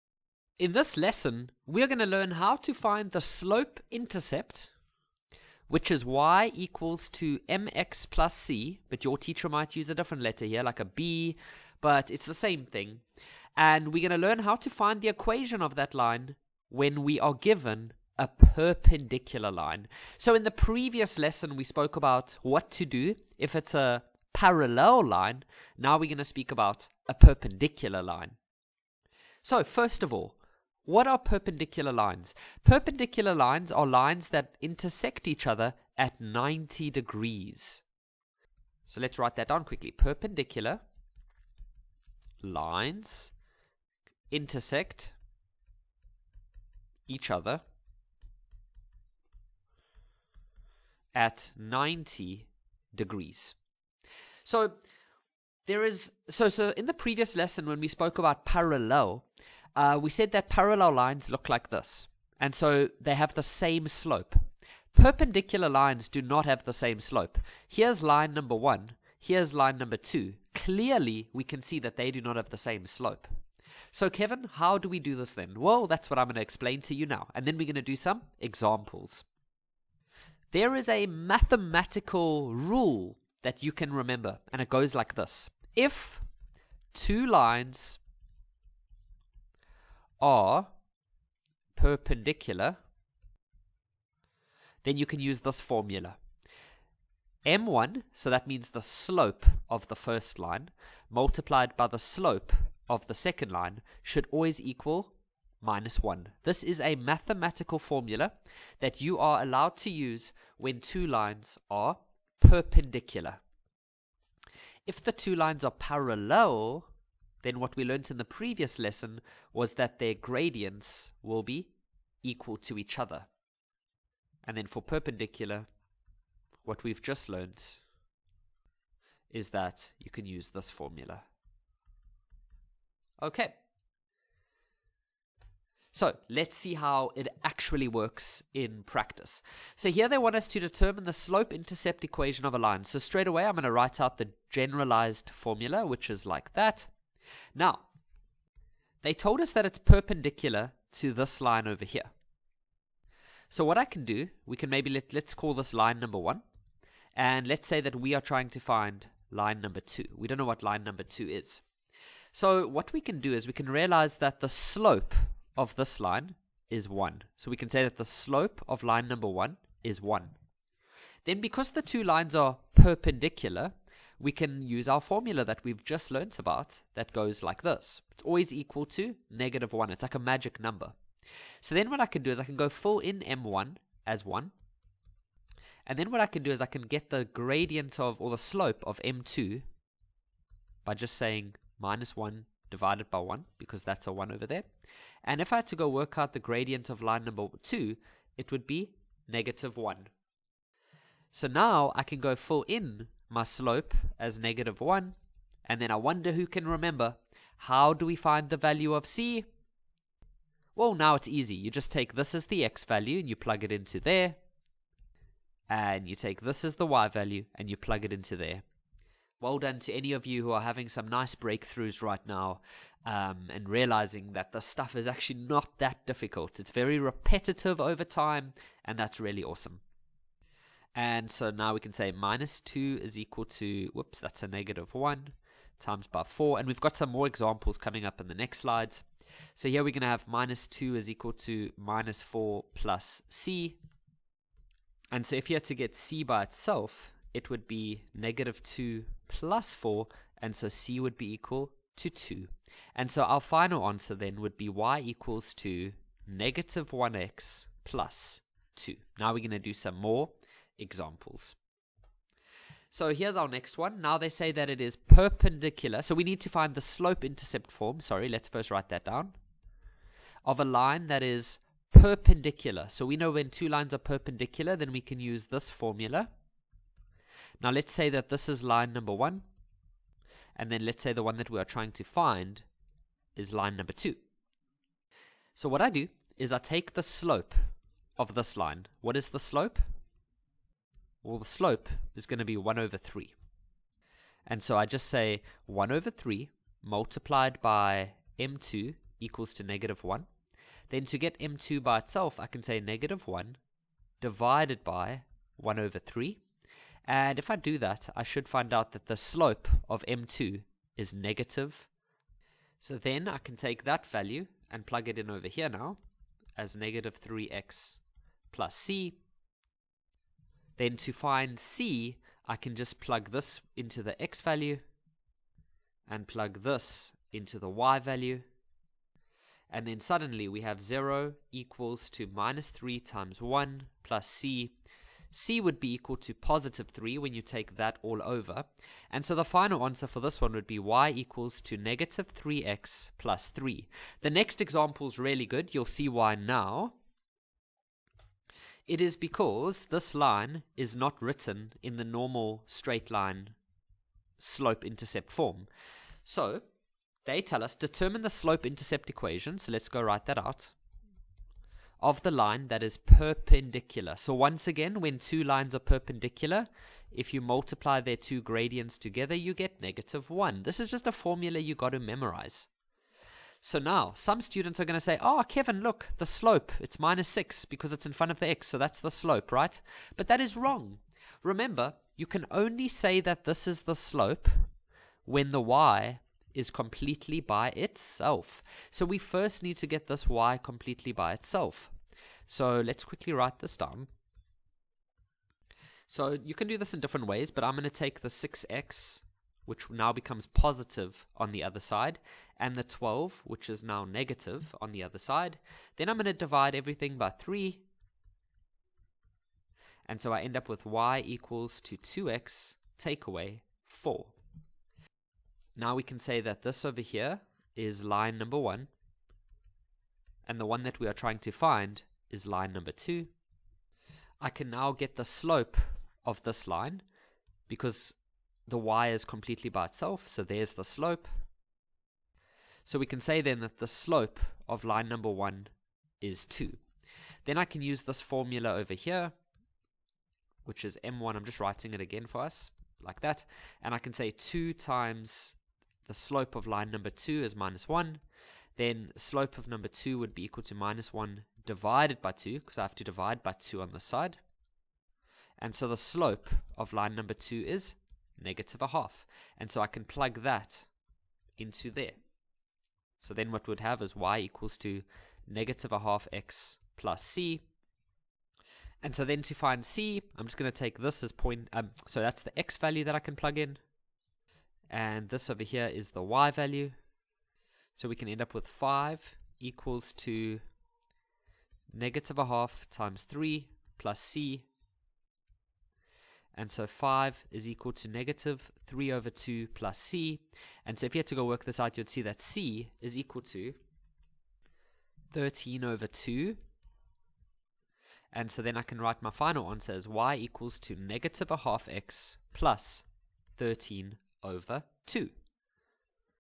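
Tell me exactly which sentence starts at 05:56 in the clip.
So they tell us determine the slope intercept equation.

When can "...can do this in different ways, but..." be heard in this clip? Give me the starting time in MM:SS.
06:36.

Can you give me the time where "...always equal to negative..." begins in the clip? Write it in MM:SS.
02:58.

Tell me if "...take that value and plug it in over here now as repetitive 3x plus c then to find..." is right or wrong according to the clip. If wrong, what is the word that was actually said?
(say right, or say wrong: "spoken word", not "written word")
wrong: "negative", not "repetitive".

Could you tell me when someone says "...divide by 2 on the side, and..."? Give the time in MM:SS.
07:33.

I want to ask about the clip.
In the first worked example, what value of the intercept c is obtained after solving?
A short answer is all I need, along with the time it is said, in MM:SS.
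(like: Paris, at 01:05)
2, at 04:10.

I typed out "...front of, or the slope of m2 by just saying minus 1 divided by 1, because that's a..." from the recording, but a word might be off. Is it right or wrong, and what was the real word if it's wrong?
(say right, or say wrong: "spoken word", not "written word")
wrong: "gradient", not "front".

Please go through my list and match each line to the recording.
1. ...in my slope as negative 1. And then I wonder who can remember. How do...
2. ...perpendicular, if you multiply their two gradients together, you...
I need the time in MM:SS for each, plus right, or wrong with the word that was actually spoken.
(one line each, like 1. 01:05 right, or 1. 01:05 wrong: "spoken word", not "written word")
1. 03:22 right
2. 06:05 right.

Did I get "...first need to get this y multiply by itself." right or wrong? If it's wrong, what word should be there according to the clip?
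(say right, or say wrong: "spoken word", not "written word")
wrong: "completely", not "multiply".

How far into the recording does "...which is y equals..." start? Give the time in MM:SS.
00:05.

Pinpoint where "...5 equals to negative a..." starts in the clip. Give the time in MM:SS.
07:58.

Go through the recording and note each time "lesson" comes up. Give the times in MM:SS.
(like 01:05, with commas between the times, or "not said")
00:00, 00:21, 00:57, 01:58.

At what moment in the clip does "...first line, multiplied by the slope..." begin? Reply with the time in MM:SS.
01:39.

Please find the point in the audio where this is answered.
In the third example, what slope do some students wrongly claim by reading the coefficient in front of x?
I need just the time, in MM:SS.
06:16.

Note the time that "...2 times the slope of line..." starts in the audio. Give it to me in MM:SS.
07:24.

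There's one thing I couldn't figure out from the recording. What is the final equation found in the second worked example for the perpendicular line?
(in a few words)
y = -3x + 3.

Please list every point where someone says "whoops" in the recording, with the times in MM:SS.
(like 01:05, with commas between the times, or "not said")
03:53.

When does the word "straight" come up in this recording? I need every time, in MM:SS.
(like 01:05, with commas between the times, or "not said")
02:22, 05:52.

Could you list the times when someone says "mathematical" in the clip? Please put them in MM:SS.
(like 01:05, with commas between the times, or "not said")
01:21, 01:46.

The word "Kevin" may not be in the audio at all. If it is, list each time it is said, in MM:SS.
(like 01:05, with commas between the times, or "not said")
01:14, 06:15.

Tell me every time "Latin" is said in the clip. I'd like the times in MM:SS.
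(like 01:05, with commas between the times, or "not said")
not said.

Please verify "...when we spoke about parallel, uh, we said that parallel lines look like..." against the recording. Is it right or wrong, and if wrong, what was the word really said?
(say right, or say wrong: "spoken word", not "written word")
right.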